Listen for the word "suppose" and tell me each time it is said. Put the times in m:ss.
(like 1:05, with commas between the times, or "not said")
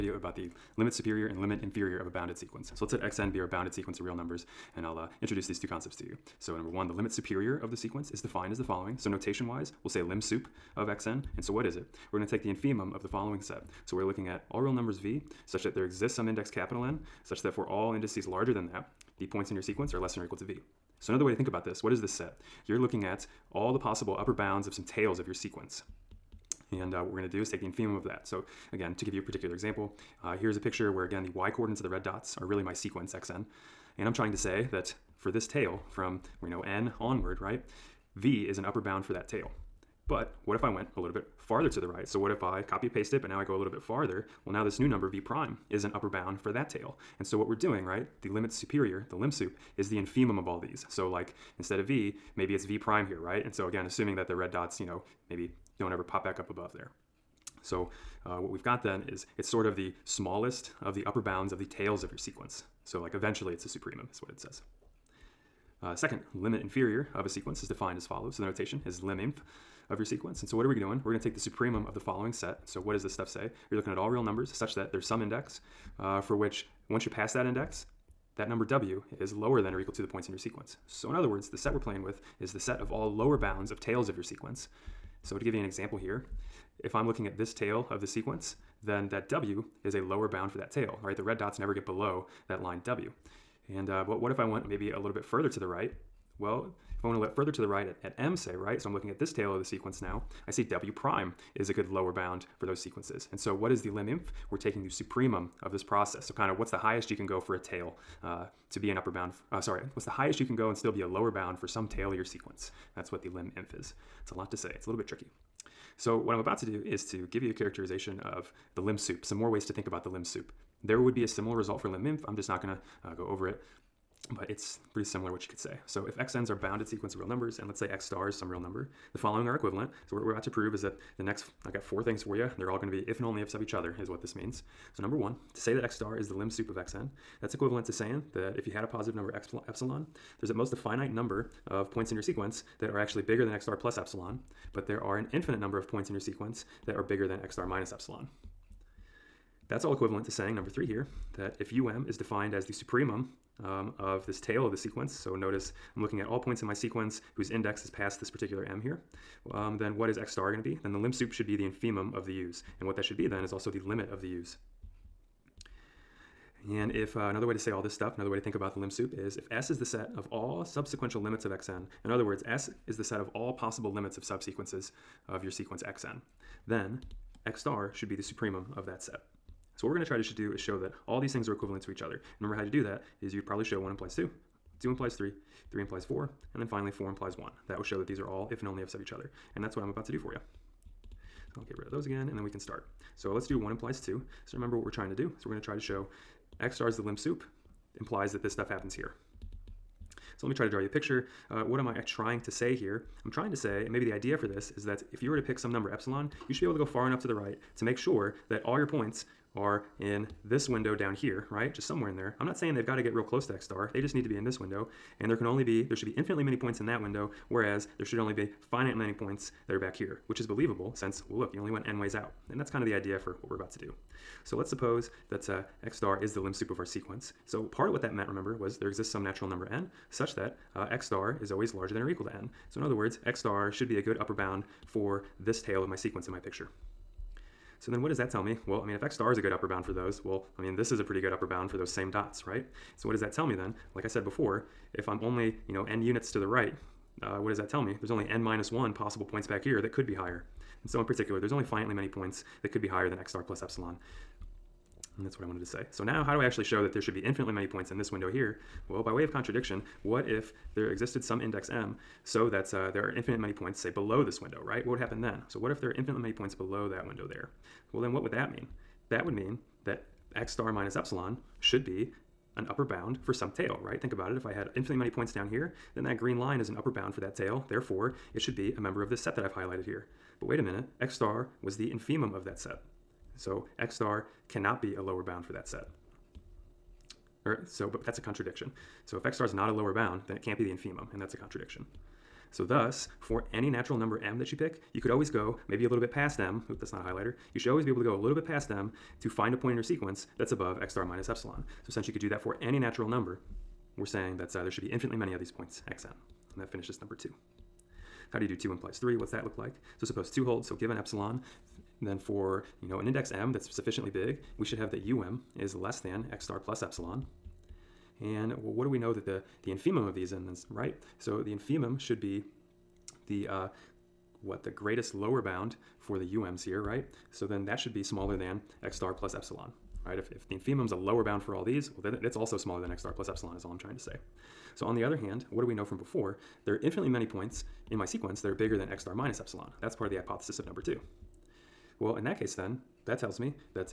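3:44, 5:10.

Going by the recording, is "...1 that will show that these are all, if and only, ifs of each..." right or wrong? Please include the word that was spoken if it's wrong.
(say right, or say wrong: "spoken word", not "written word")
right.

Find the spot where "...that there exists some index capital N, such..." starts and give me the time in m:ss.
0:15.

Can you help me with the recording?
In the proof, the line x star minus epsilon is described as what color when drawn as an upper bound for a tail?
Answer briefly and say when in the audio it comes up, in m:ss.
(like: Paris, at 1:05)
green, at 4:36.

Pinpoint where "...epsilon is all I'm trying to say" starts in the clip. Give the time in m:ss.
5:33.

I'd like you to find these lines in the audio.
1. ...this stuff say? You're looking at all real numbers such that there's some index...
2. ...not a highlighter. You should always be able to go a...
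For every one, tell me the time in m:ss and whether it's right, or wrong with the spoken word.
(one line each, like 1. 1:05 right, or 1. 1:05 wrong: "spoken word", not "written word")
1. 1:13 right
2. 4:56 right.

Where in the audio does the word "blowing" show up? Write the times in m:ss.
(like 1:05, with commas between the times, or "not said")
not said.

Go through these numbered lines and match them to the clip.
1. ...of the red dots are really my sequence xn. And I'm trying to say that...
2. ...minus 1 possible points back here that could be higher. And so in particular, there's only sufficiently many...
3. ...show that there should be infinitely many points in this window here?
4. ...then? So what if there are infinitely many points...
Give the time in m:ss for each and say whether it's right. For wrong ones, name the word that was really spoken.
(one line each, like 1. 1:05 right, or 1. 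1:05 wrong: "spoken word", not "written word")
1. 0:31 right
2. 4:08 wrong: "finitely", not "sufficiently"
3. 4:16 right
4. 4:25 right.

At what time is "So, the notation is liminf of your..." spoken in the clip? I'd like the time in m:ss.
1:08.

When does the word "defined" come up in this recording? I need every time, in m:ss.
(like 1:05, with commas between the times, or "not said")
0:08, 1:07, 2:32.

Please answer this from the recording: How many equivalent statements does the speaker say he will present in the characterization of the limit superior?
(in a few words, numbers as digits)
4.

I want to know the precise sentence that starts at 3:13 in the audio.
So let's do 1 implies 2.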